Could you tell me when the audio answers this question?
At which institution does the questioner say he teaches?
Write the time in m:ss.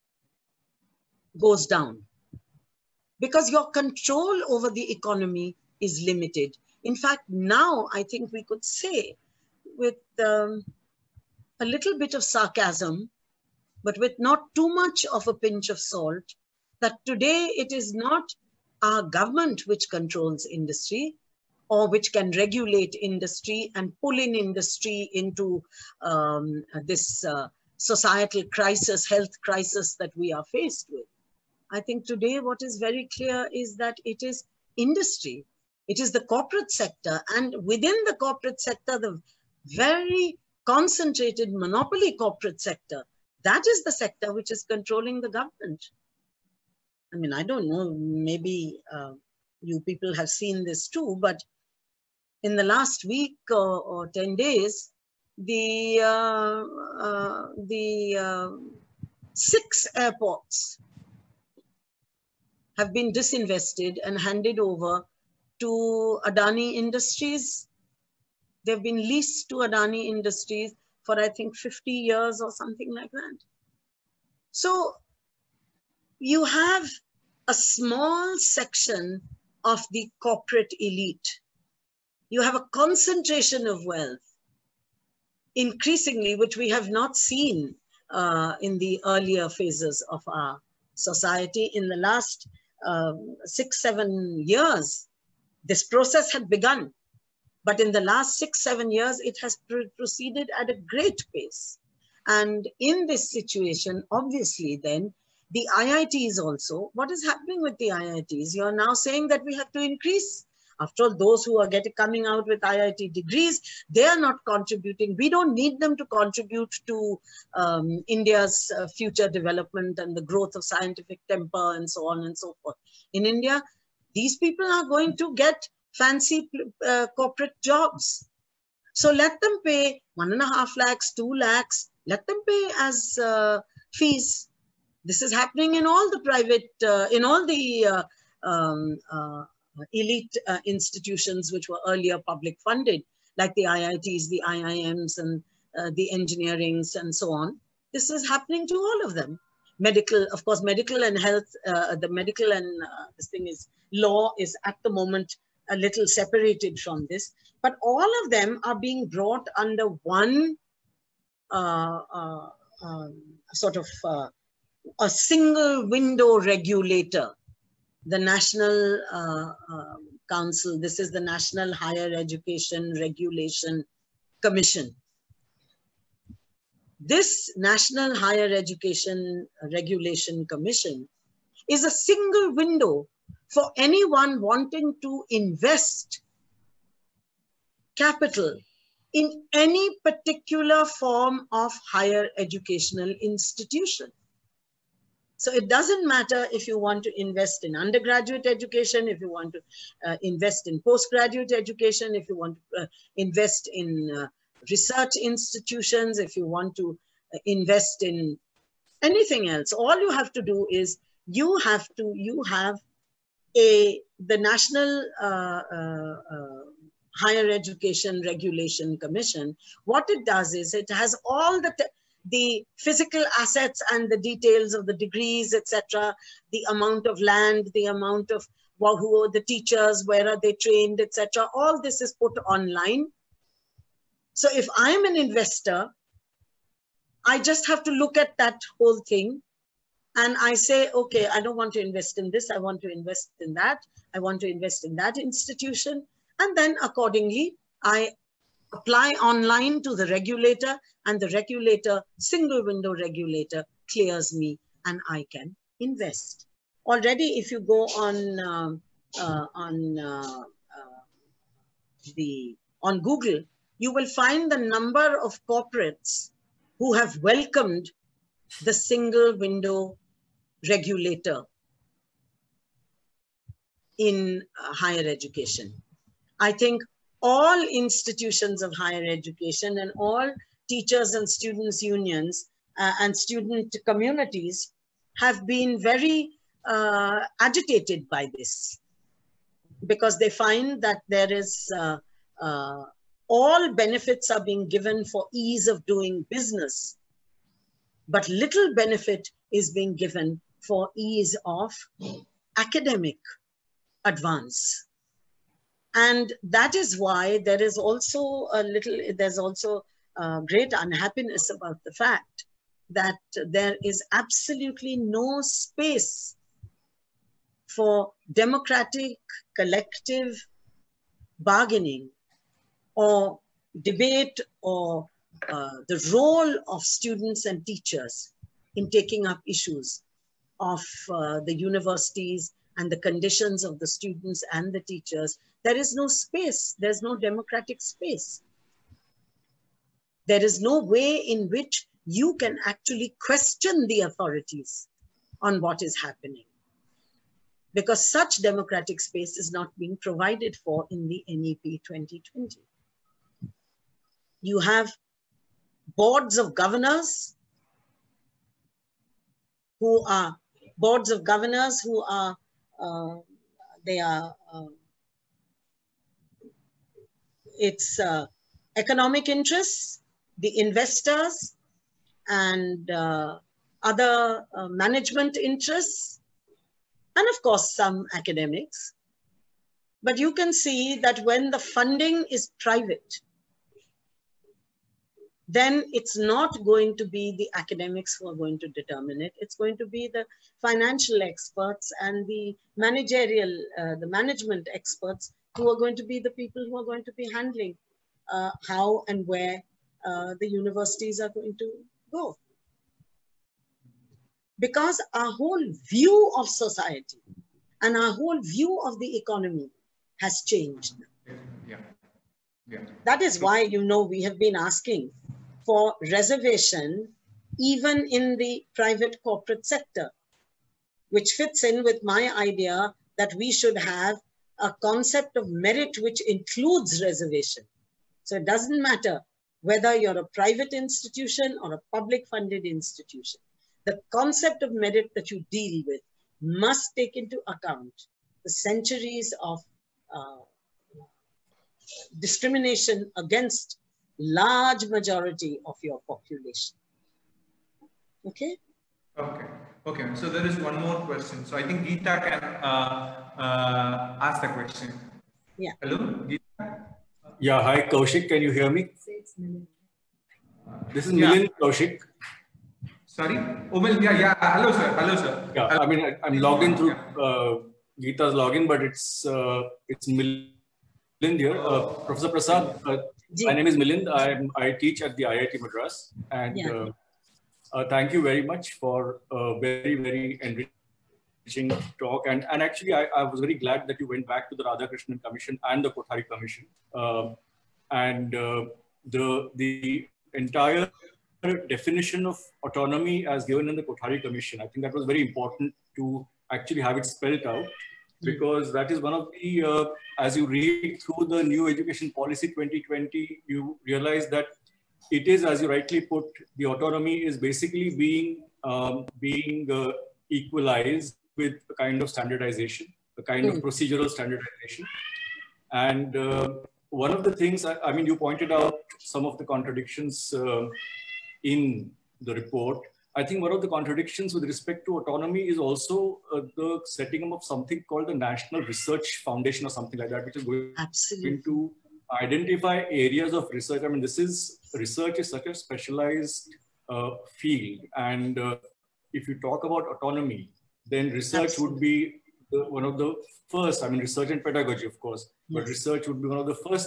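7:55.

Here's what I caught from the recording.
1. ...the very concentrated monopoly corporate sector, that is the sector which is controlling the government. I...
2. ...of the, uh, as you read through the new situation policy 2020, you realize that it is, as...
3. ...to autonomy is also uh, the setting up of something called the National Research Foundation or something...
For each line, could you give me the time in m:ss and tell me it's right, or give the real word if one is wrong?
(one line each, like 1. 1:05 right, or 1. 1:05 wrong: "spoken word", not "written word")
1. 0:38 right
2. 8:19 wrong: "education", not "situation"
3. 8:44 right.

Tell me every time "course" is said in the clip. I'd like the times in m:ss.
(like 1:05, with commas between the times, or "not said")
2:30, 6:17, 9:04.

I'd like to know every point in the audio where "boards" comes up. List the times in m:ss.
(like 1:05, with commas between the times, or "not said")
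5:55, 6:00.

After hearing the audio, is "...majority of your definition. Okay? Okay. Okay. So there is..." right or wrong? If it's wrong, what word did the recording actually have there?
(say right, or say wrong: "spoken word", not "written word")
wrong: "population", not "definition".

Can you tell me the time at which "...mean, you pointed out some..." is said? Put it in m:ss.
8:37.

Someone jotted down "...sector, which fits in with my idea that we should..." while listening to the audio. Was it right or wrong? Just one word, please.
right.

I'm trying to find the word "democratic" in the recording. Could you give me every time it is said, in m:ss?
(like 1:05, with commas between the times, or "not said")
5:18, 5:37, 5:48.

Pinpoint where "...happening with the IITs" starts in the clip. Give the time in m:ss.
1:47.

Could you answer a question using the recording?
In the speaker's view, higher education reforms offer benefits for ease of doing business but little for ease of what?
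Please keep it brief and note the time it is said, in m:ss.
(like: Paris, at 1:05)
academic advance, at 5:02.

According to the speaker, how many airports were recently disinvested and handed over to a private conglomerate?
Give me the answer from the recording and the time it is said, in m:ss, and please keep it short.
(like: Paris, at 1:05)
6, at 0:59.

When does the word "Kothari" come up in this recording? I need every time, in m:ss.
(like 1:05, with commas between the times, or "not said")
8:05, 8:13.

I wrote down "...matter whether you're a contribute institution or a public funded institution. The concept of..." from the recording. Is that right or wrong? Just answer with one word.
wrong.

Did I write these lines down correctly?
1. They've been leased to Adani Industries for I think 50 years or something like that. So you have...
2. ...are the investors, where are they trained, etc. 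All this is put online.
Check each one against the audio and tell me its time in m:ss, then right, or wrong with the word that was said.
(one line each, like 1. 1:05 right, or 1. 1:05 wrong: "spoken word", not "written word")
1. 1:08 right
2. 3:49 wrong: "teachers", not "investors".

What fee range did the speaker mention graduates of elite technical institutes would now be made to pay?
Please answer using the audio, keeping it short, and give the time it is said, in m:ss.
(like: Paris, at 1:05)
1.5 to 2 lakhs, at 2:10.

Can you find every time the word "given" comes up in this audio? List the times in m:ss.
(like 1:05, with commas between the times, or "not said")
4:54, 4:59, 8:13.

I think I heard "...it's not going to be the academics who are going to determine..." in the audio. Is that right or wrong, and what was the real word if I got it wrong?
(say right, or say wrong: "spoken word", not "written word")
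right.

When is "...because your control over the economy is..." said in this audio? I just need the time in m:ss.
0:03.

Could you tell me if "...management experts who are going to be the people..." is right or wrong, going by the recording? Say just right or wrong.
right.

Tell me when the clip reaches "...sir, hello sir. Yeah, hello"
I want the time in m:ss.
7:44.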